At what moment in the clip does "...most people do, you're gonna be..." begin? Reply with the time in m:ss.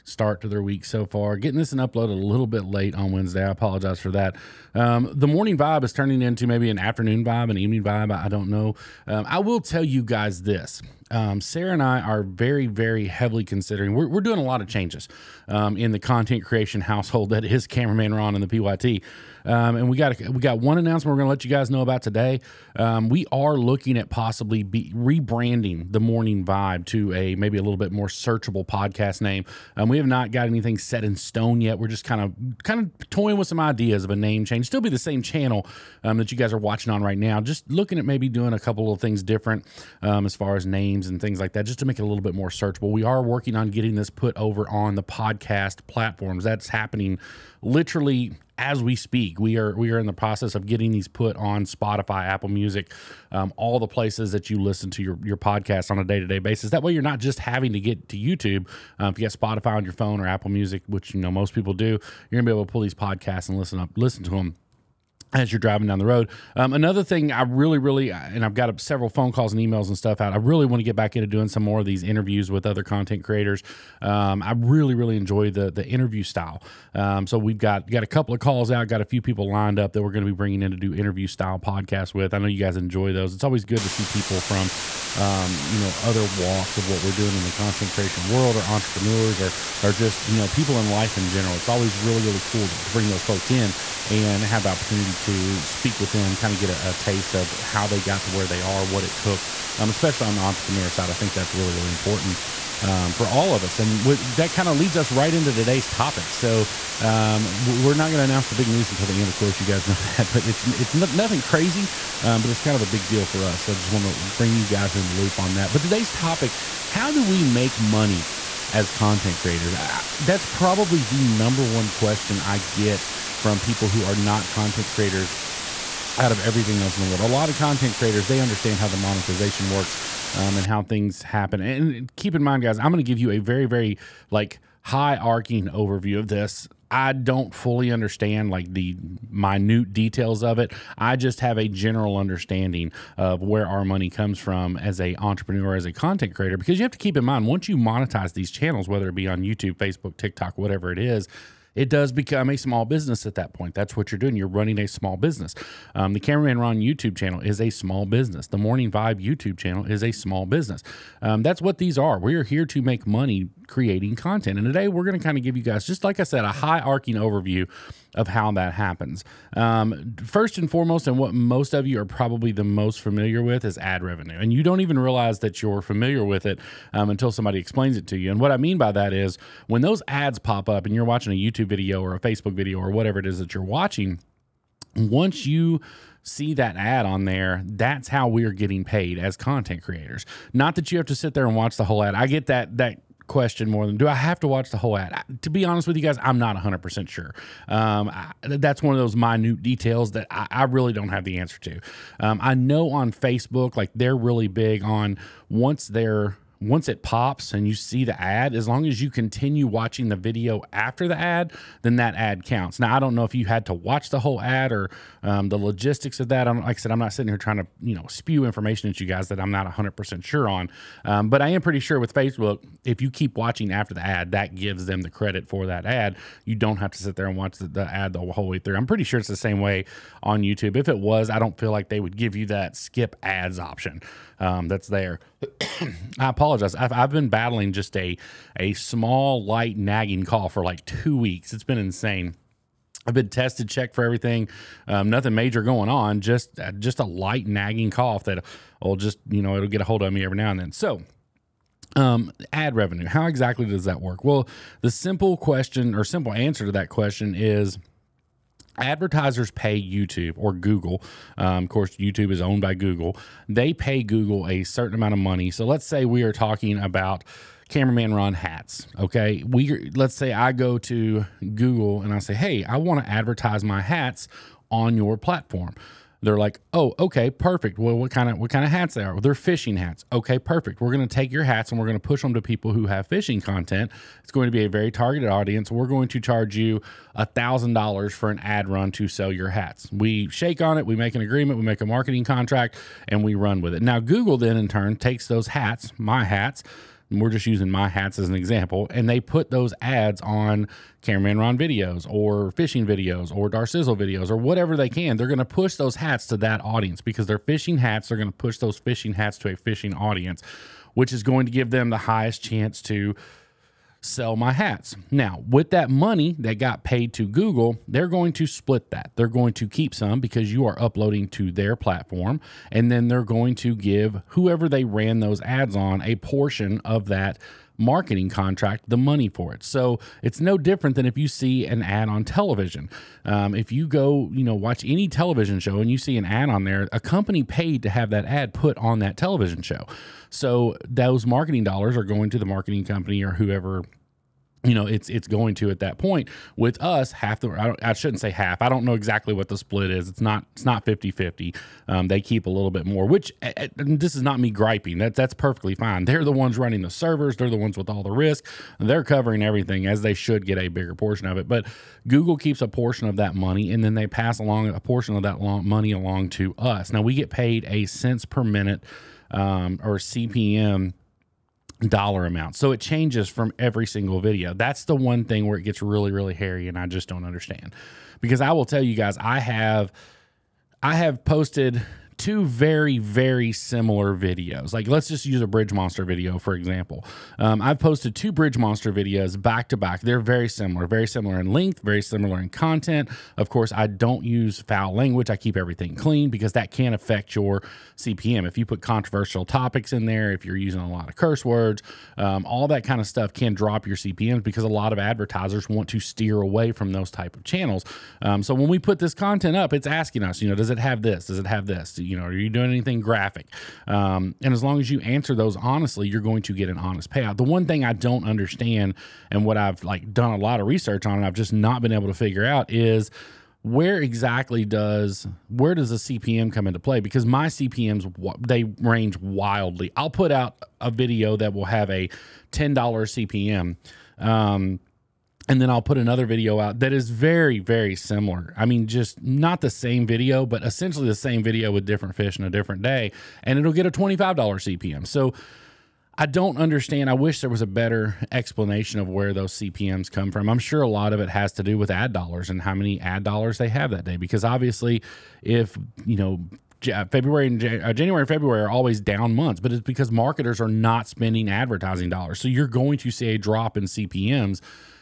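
1:01.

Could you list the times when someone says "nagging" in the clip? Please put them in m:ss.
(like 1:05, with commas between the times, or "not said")
3:59, 4:07.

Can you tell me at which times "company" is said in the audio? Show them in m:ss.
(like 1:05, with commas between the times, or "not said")
5:36, 5:42.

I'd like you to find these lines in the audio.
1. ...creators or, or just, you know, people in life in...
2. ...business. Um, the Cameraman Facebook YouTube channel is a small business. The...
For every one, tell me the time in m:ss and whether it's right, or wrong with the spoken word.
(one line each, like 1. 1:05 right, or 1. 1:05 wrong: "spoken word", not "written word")
1. 1:28 wrong: "entrepreneurs", not "creators"
2. 2:35 wrong: "Ron", not "Facebook".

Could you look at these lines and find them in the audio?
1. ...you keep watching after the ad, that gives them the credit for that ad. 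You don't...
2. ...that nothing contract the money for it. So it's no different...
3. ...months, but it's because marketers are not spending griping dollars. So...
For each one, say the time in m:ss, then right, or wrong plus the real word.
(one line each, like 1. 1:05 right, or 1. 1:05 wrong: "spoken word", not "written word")
1. 3:43 right
2. 5:27 wrong: "marketing", not "nothing"
3. 7:39 wrong: "advertising", not "griping".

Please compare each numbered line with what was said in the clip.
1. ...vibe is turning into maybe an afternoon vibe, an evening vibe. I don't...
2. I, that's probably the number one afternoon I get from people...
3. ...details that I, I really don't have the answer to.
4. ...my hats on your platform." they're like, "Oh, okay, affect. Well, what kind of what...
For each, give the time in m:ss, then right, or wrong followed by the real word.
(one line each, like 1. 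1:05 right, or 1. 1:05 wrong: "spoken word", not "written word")
1. 0:05 right
2. 1:59 wrong: "question", not "afternoon"
3. 3:19 right
4. 4:33 wrong: "perfect", not "affect".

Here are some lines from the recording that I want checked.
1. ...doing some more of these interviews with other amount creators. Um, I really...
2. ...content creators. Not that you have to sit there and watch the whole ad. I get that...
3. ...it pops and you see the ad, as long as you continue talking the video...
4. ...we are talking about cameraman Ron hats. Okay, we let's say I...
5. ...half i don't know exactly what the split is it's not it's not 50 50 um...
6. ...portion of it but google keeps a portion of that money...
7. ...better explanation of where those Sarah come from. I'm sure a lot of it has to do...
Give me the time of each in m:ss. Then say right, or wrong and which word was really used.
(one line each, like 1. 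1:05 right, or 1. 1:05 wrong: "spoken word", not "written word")
1. 1:11 wrong: "content", not "amount"
2. 3:09 right
3. 3:26 wrong: "watching", not "talking"
4. 4:26 right
5. 5:48 right
6. 6:00 right
7. 7:27 wrong: "CPMs", not "Sarah".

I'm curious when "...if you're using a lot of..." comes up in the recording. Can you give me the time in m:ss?
6:40.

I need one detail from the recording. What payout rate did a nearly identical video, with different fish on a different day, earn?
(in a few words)
$25.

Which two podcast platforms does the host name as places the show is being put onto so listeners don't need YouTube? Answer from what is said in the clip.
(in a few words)
Spotify, Apple Music.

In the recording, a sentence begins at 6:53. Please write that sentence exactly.
Um, and as long as you answer those honestly, you're going to get an honest payout.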